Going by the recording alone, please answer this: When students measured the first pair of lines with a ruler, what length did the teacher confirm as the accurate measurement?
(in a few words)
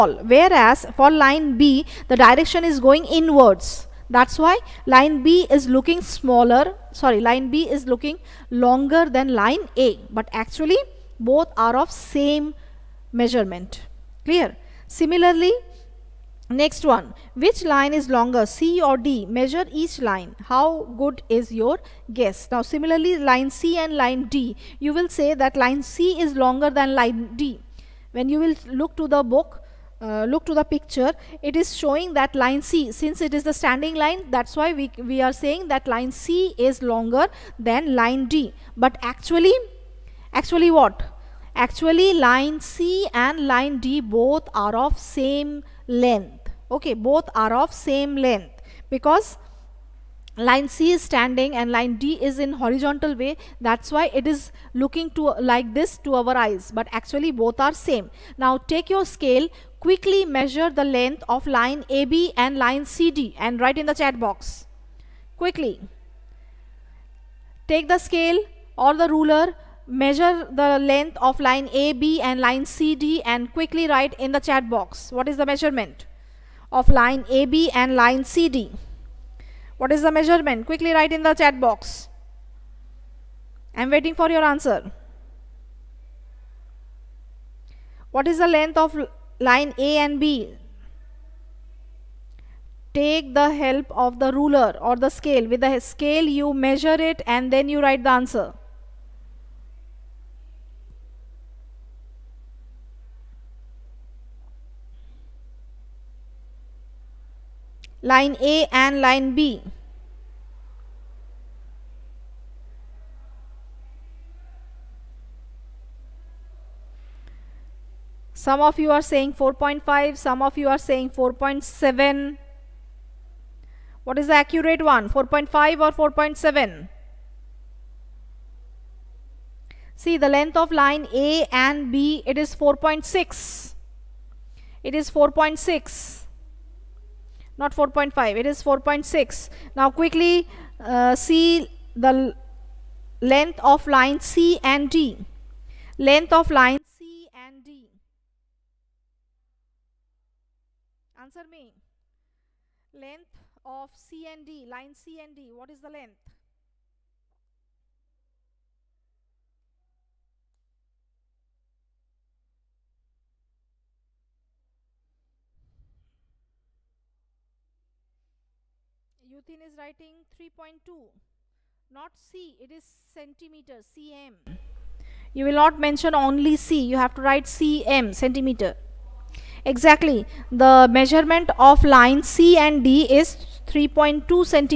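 4.6.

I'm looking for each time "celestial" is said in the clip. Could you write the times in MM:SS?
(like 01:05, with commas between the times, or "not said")
not said.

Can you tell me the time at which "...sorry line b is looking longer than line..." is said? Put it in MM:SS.
00:06.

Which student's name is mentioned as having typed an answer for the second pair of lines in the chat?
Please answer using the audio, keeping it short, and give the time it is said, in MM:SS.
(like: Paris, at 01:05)
Yuthin, at 02:49.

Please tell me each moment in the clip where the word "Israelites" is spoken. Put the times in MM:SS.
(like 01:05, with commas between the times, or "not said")
not said.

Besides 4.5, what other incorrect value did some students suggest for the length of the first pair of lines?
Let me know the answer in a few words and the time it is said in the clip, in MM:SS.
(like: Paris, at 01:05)
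4.7, at 02:00.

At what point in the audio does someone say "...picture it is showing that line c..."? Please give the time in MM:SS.
00:30.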